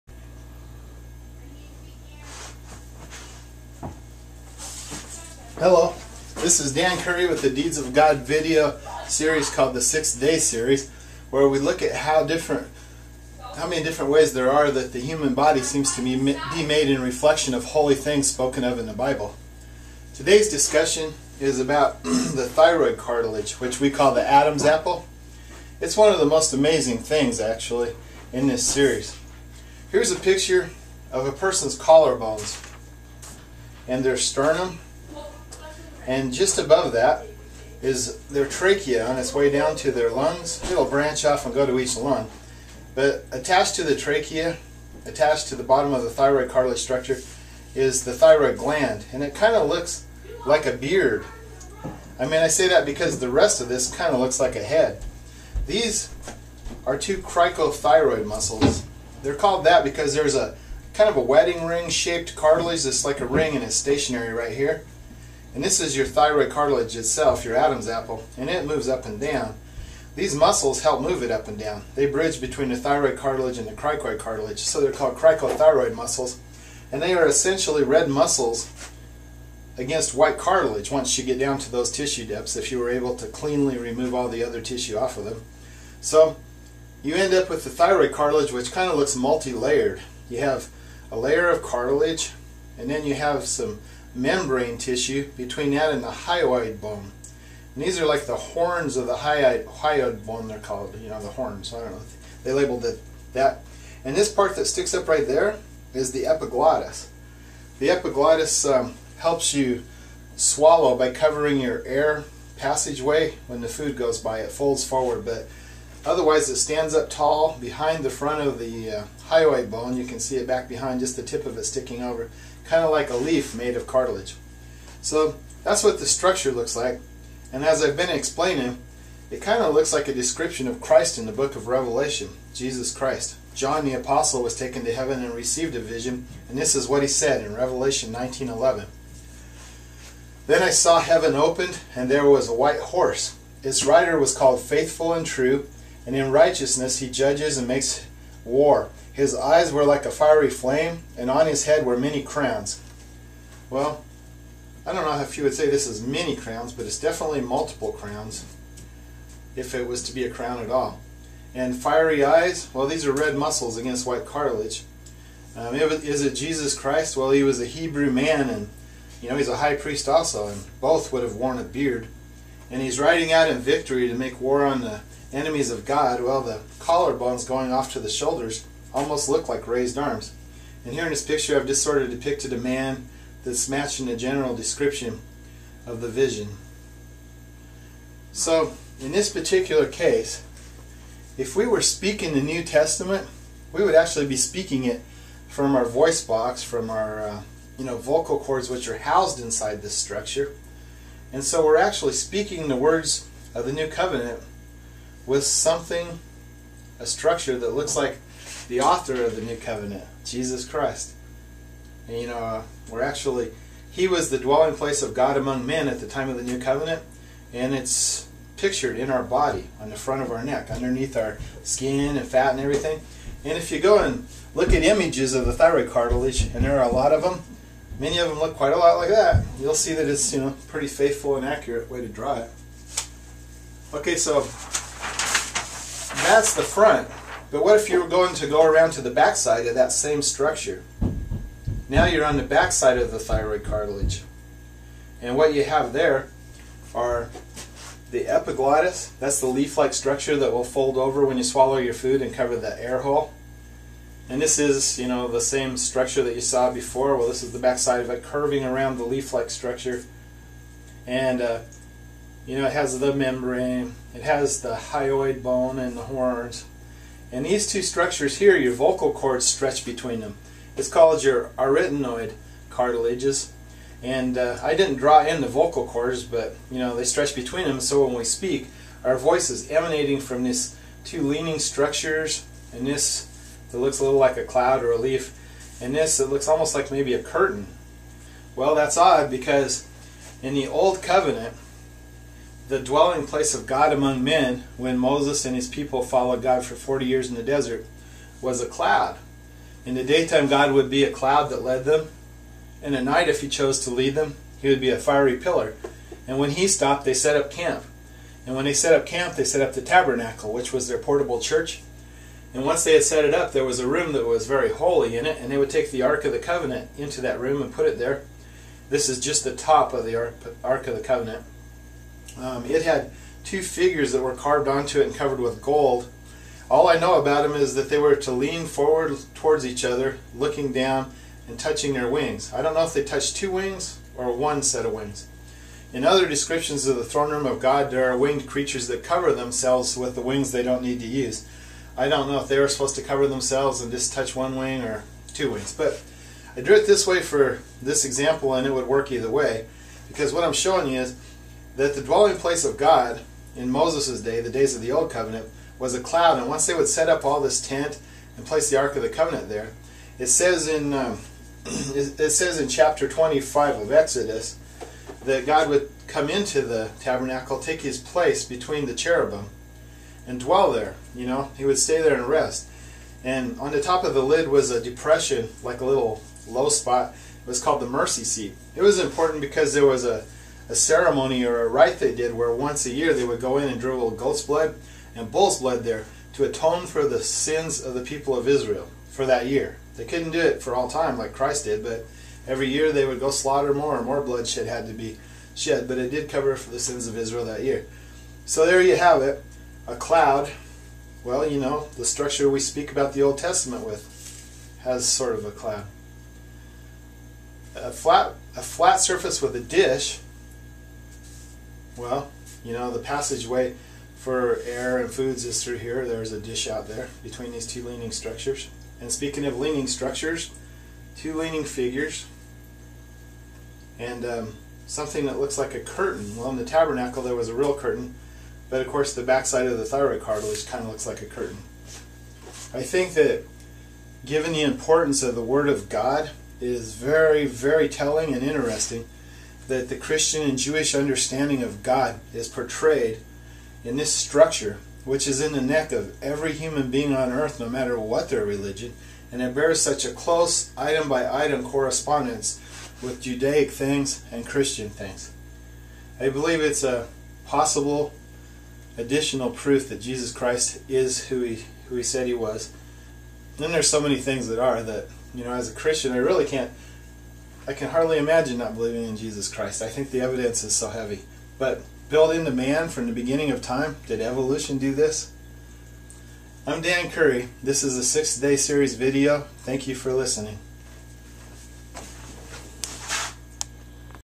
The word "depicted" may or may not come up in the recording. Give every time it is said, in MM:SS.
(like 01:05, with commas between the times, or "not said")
03:02.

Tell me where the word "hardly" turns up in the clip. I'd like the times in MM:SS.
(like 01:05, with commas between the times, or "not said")
07:47.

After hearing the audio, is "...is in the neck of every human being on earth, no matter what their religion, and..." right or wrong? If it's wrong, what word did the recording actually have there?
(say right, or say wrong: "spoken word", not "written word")
right.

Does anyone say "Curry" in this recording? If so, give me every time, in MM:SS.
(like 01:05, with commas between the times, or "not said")
00:06, 07:57.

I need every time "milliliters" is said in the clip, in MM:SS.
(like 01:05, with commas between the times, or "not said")
not said.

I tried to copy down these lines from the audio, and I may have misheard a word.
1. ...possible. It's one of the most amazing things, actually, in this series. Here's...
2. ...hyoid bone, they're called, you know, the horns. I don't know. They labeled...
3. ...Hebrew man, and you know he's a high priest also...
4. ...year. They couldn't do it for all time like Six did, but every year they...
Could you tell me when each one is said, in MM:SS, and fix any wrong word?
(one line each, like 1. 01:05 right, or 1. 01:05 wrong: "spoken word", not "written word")
1. 00:24 wrong: "apple", not "possible"
2. 01:39 right
3. 02:47 right
4. 06:29 wrong: "Christ", not "Six".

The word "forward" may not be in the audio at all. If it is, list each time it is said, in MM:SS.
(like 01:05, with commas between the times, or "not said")
01:54, 05:28.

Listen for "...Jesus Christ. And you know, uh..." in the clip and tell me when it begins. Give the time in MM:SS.
03:30.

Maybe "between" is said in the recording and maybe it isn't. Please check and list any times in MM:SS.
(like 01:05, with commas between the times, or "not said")
01:12, 01:35, 04:29, 04:37, 06:08, 06:57.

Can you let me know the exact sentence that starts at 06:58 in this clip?
And speaking of leaning structures, two leaning figures, and um, something that looks like a curtain.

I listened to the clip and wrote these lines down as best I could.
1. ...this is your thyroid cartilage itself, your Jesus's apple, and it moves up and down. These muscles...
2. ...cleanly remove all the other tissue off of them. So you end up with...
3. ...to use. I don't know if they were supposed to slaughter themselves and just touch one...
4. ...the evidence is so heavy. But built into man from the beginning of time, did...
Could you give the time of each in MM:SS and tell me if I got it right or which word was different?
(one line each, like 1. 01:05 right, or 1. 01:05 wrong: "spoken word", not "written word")
1. 01:05 wrong: "Adam", not "Jesus"
2. 01:23 right
3. 05:40 wrong: "cover", not "slaughter"
4. 07:50 right.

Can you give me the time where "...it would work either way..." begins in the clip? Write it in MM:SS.
05:48.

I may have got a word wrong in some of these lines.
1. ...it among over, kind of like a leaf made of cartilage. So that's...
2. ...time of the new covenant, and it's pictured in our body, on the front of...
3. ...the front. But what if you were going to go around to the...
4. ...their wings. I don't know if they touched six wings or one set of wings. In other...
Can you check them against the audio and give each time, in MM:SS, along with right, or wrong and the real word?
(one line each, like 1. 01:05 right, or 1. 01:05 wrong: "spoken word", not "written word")
1. 02:01 wrong: "sticking", not "among"
2. 03:36 right
3. 03:56 right
4. 05:31 wrong: "two", not "six".